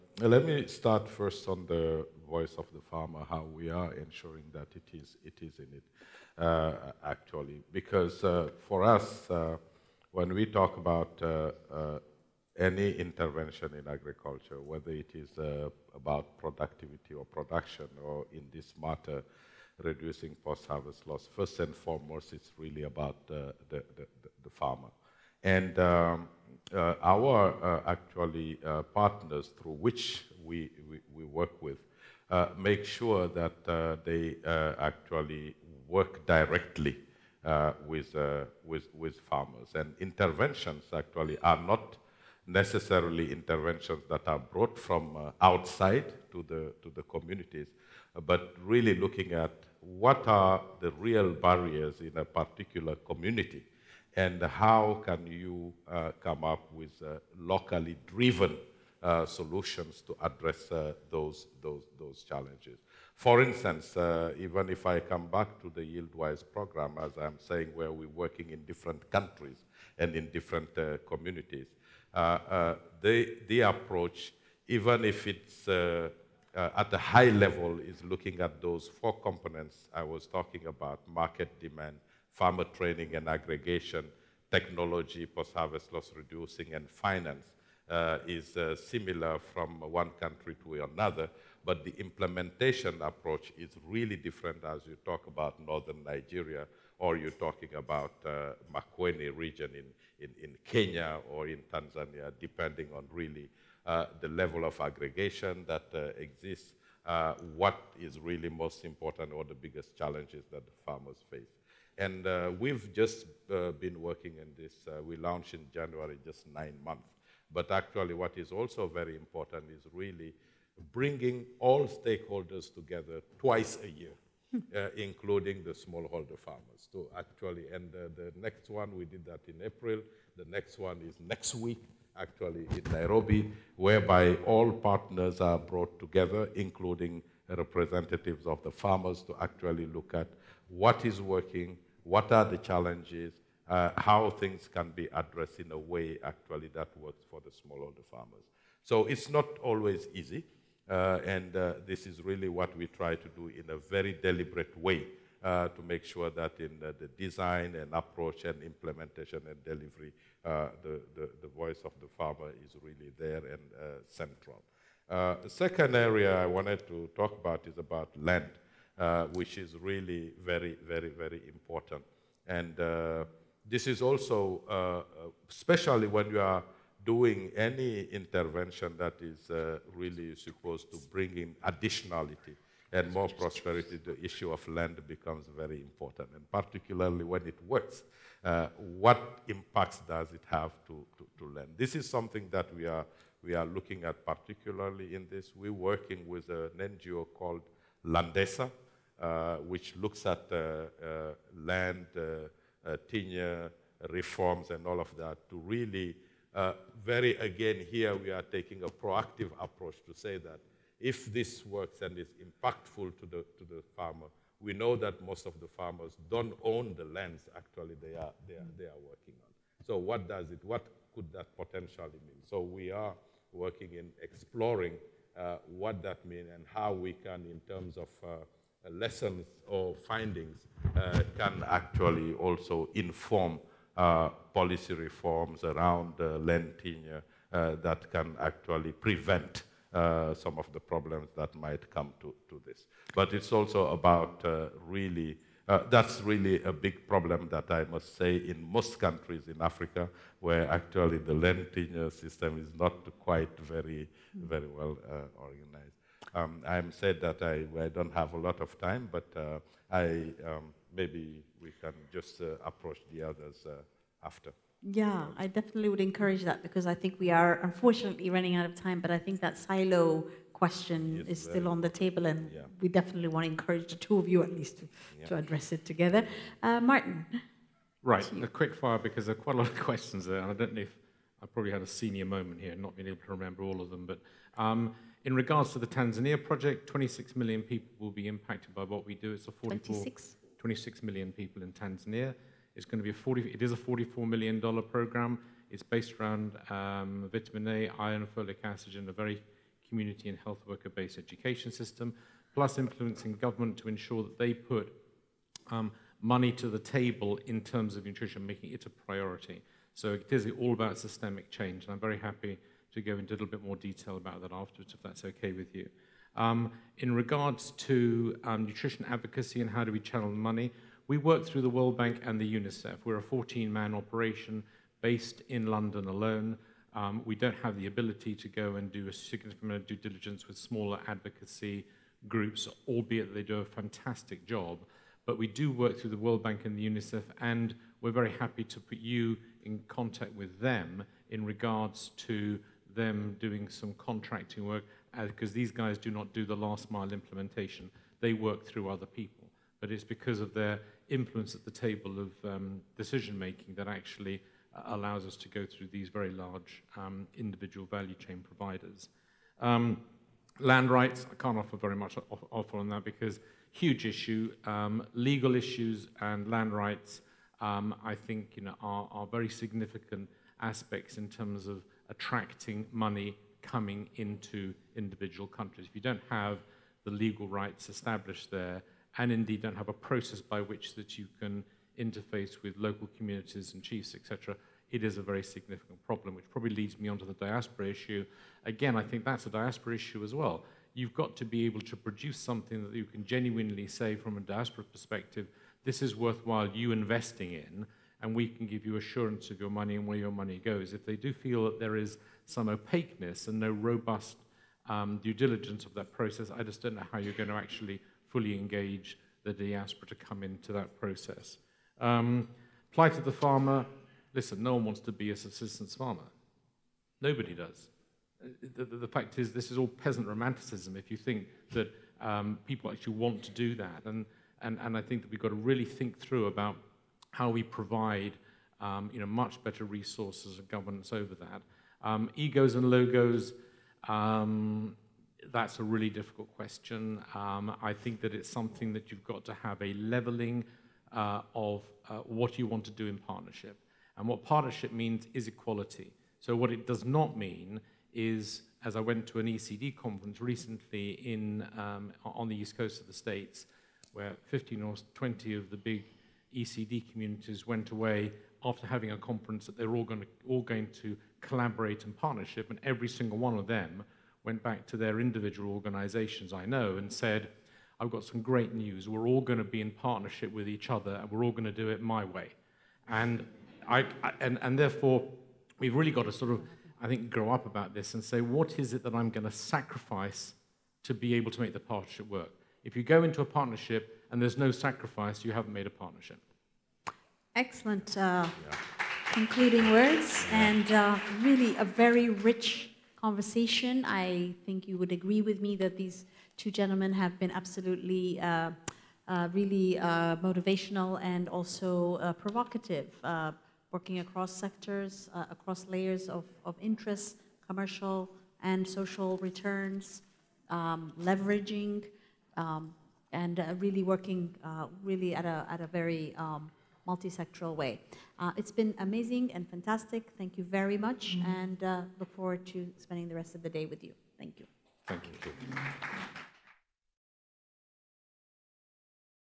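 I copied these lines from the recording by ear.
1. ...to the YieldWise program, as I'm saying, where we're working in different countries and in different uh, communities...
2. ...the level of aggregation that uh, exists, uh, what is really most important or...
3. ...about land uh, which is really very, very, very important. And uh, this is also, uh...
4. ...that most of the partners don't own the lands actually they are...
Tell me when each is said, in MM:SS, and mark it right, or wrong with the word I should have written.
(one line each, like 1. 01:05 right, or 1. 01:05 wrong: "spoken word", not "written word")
1. 01:05 right
2. 01:44 right
3. 02:47 right
4. 03:34 wrong: "farmers", not "partners".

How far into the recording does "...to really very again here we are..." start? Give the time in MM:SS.
03:25.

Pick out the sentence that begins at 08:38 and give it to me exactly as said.
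Uh, it's been amazing and fantastic.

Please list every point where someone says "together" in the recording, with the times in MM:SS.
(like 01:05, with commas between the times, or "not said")
02:02, 02:15, 04:35.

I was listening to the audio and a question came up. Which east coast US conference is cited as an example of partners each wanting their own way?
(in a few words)
ECD conference.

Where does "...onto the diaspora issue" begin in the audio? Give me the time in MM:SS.
06:27.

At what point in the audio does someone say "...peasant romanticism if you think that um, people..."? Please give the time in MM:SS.
06:59.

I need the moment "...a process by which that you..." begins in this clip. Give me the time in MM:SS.
06:19.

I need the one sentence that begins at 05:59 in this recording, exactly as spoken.
Um, land rights, I can't offer very much offer on that because huge issue.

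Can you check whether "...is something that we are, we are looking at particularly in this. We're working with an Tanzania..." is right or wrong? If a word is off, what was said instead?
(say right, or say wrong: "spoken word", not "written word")
wrong: "NGO", not "Tanzania".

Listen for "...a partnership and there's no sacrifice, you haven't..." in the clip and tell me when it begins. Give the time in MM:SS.
08:03.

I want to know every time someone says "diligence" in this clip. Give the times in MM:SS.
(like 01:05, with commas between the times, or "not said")
05:29, 06:45.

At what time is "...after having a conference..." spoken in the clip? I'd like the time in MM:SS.
07:38.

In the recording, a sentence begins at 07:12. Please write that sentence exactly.
Um, egos and logos, um, that's a really difficult question.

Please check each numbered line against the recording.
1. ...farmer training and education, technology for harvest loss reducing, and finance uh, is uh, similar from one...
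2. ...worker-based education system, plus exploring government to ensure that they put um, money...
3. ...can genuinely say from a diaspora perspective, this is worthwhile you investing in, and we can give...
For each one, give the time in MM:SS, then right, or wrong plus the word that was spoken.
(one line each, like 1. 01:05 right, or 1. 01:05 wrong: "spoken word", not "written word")
1. 01:22 wrong: "aggregation", not "education"
2. 05:00 wrong: "influencing", not "exploring"
3. 06:33 right.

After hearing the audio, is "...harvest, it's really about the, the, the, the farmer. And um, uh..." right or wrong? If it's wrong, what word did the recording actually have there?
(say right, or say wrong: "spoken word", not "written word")
wrong: "foremost", not "harvest".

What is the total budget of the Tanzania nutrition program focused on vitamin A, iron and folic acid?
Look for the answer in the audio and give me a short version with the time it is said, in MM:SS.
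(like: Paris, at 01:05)
$44 million, at 04:53.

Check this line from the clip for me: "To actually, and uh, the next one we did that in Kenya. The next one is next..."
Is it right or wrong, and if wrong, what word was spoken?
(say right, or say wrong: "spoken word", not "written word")
wrong: "April", not "Kenya".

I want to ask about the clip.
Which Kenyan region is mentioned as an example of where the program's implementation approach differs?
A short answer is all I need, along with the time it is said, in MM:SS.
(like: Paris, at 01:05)
Makueni, at 01:38.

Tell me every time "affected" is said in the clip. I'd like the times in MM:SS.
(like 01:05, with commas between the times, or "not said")
not said.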